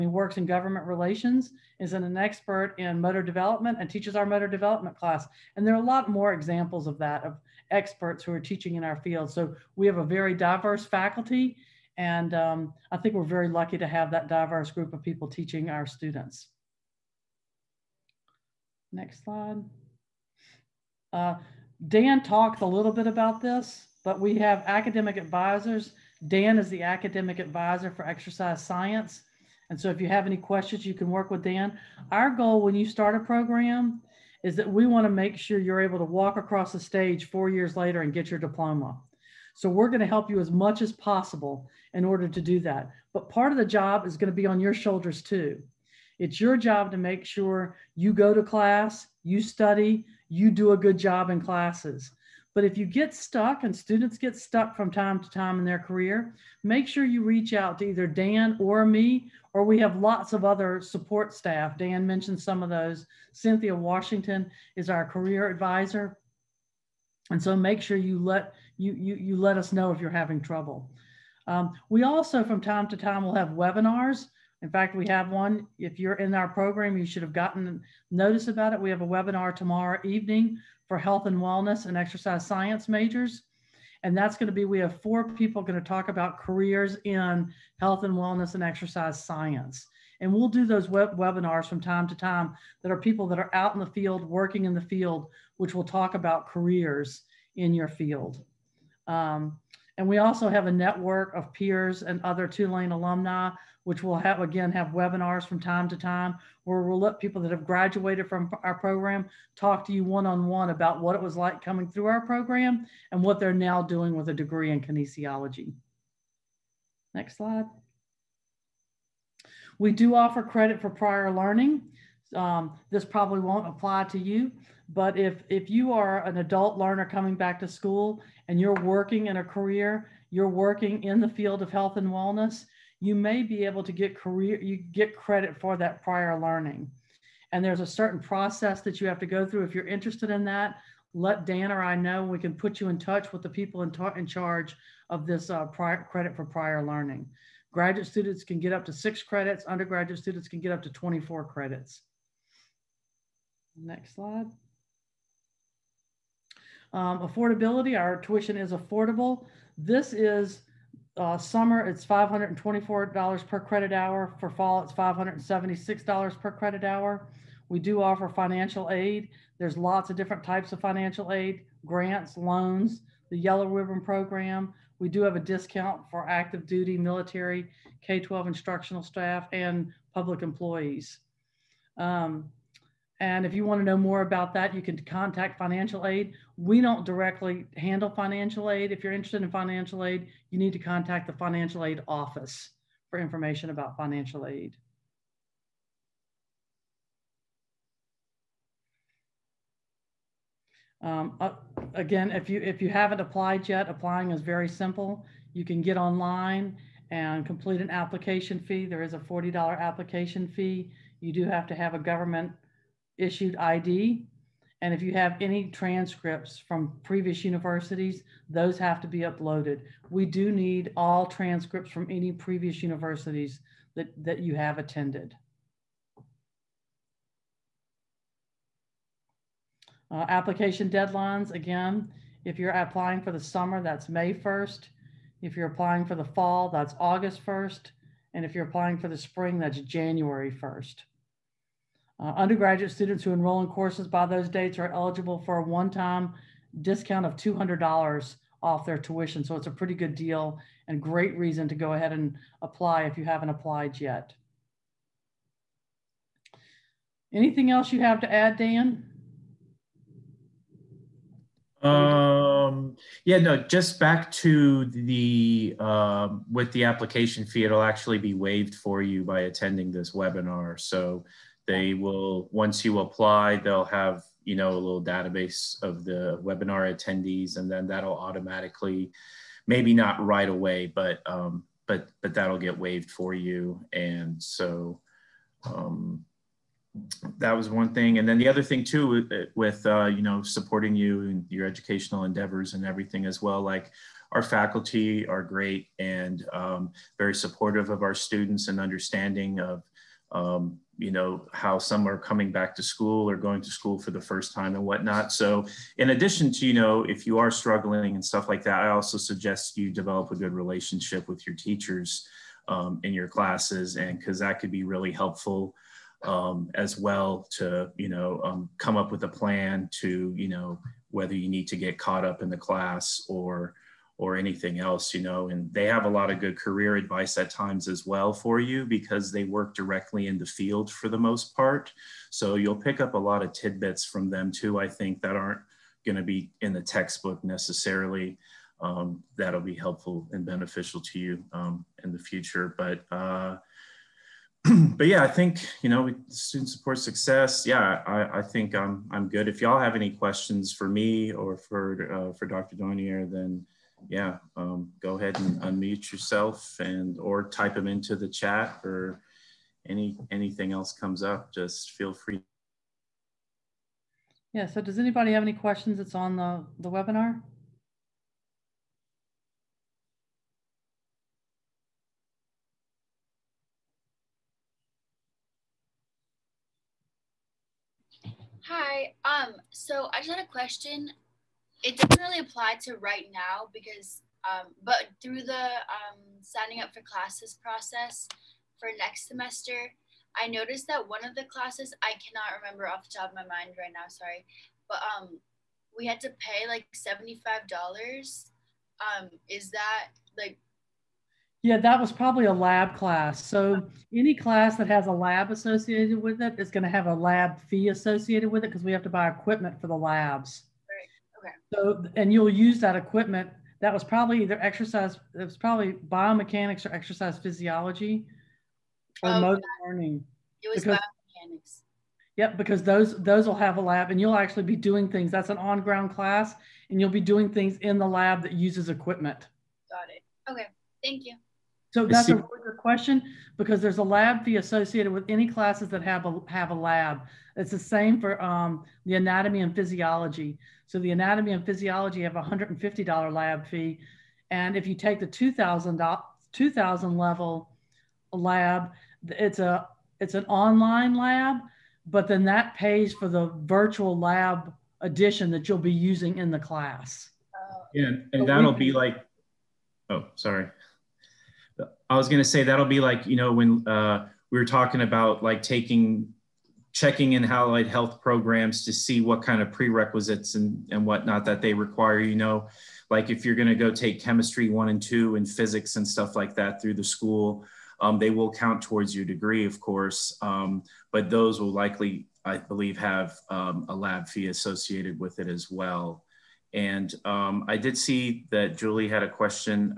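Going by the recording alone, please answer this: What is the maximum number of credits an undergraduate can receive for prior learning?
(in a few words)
24.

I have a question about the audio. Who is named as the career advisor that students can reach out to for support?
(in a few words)
Cynthia Washington.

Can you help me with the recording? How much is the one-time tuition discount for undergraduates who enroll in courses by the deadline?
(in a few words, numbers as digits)
$200.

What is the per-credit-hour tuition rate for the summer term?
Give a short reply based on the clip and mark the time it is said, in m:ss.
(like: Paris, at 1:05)
$524, at 2:42.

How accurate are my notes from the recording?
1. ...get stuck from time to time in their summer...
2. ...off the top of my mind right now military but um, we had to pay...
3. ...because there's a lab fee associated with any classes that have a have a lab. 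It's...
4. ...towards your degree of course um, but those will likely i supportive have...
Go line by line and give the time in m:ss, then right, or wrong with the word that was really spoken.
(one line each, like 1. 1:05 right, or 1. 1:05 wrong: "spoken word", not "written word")
1. 0:54 wrong: "career", not "summer"
2. 6:32 wrong: "sorry", not "military"
3. 7:13 right
4. 7:58 wrong: "believe", not "supportive".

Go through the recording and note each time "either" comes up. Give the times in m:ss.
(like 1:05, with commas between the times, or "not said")
0:57, 6:54.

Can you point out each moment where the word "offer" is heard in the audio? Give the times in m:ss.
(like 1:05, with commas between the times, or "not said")
2:00, 2:48.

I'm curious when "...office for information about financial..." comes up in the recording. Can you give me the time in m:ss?
3:12.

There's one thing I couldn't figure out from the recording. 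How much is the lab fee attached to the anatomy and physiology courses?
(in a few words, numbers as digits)
$150.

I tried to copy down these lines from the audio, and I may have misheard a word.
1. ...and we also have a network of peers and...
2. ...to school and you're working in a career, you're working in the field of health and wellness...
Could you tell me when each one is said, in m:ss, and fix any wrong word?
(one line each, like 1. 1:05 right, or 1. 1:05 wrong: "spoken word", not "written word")
1. 1:39 right
2. 2:07 right.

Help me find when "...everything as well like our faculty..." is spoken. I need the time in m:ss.
4:52.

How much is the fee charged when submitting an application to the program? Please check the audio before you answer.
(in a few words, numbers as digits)
$40.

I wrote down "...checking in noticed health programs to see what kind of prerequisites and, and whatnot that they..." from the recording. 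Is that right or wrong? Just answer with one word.
wrong.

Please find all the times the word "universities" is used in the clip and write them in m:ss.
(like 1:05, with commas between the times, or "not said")
3:37, 3:42.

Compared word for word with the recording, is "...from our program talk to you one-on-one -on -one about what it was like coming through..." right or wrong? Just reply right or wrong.
right.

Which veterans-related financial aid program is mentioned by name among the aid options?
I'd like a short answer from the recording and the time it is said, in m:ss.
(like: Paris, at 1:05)
Yellow Ribbon Program, at 2:53.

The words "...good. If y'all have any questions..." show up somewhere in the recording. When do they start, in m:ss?
5:49.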